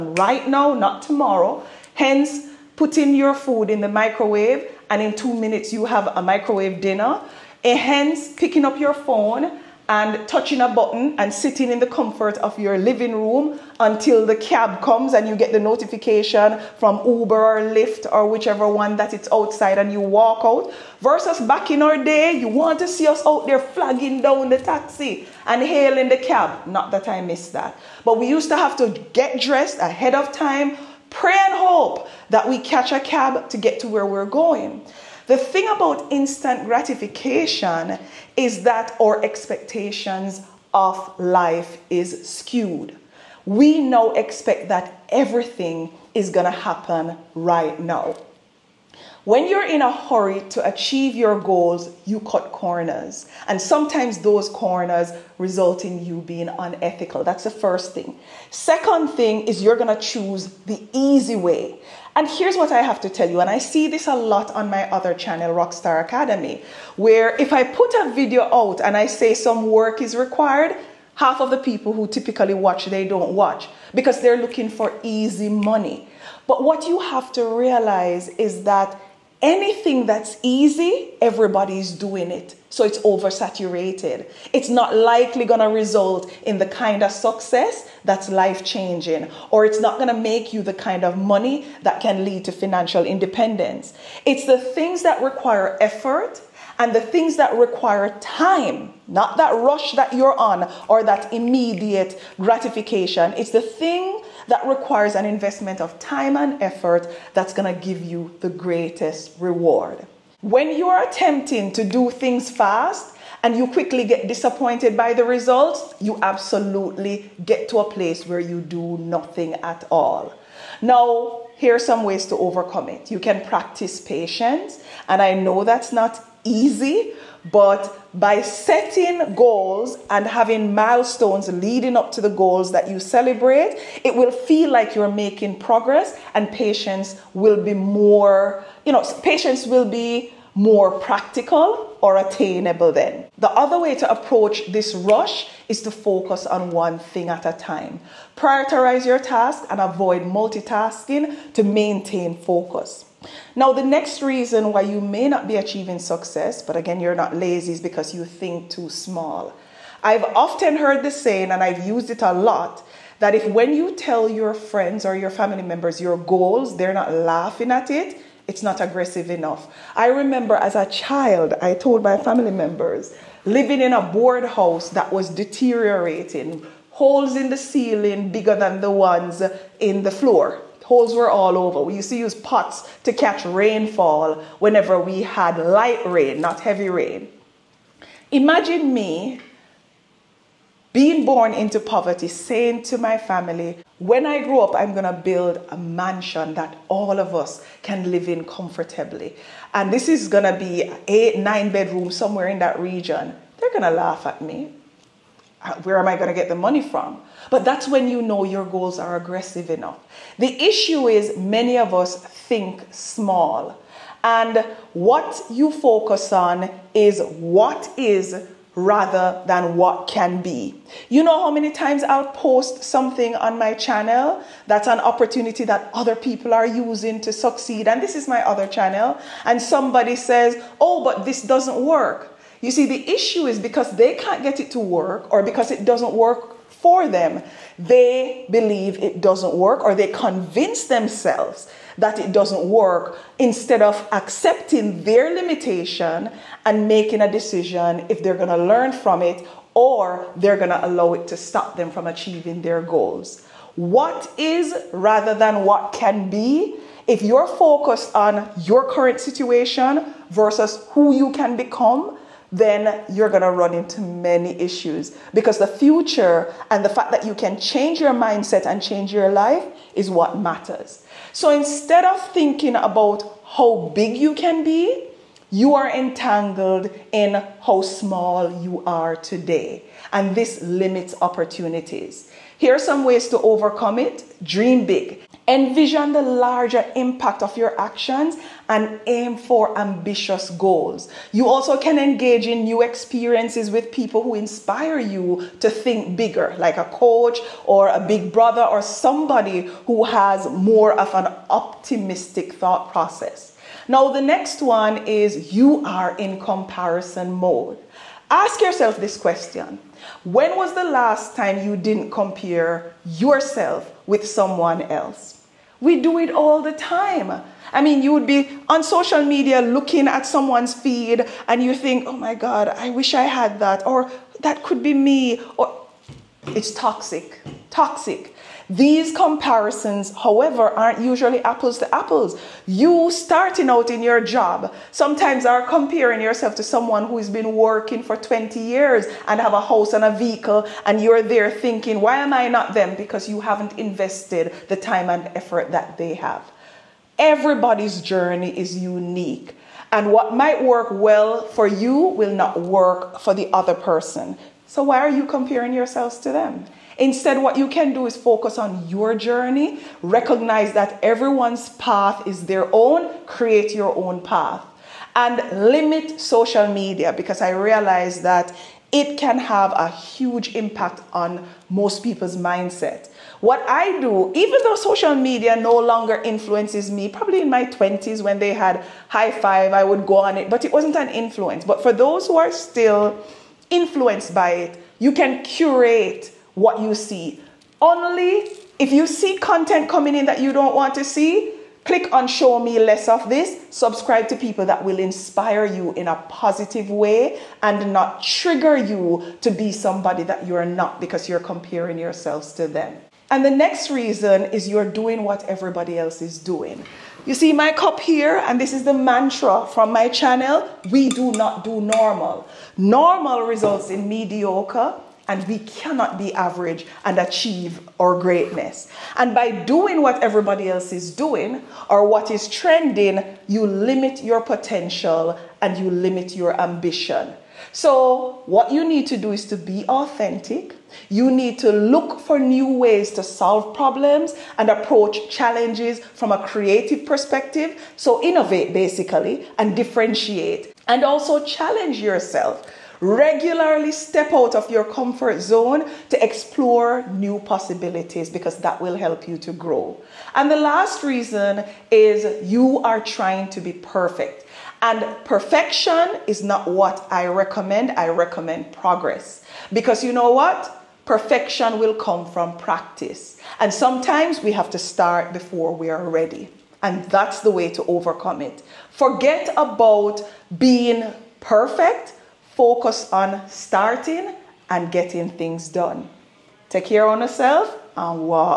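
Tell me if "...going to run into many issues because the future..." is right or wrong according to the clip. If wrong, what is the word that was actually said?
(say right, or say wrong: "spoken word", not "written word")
right.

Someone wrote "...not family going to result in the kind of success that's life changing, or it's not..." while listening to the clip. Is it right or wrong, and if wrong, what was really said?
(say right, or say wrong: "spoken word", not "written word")
wrong: "likely", not "family".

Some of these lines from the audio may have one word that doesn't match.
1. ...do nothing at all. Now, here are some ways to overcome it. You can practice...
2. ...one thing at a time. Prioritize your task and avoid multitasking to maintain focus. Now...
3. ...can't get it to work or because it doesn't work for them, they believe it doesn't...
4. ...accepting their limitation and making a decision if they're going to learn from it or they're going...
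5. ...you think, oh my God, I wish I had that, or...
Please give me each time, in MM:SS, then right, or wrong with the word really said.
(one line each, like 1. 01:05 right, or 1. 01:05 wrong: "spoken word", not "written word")
1. 01:58 right
2. 02:26 right
3. 03:54 right
4. 04:04 right
5. 05:21 right.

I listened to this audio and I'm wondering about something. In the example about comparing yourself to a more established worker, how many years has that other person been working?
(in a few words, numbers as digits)
20 years.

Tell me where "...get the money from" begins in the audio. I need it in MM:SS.
03:26.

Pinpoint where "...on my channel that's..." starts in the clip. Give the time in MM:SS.
03:43.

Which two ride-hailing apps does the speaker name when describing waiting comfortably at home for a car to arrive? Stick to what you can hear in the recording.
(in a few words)
Uber or Lyft.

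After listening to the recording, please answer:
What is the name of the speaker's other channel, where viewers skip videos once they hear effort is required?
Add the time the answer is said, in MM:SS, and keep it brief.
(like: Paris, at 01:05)
Rockstar Academy, at 01:05.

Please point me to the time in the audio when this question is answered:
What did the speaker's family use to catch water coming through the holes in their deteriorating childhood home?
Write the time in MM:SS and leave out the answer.
03:02.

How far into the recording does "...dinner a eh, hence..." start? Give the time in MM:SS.
00:06.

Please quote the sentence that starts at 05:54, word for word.
So, why are you comparing yourselves to them?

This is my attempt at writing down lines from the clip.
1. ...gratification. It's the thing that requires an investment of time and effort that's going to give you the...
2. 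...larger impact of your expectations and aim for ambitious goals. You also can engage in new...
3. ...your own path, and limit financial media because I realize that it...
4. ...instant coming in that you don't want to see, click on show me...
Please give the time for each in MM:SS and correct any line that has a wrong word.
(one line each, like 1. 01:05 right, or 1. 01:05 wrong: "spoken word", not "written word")
1. 01:42 right
2. 04:46 wrong: "actions", not "expectations"
3. 06:03 wrong: "social", not "financial"
4. 06:29 wrong: "content", not "instant".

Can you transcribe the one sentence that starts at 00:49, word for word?
When you're in a hurry to achieve your goals, you cut corners.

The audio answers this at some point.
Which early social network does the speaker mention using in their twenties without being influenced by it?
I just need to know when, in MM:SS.
06:19.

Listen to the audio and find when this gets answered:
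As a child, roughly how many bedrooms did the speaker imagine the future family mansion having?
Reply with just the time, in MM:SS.
03:21.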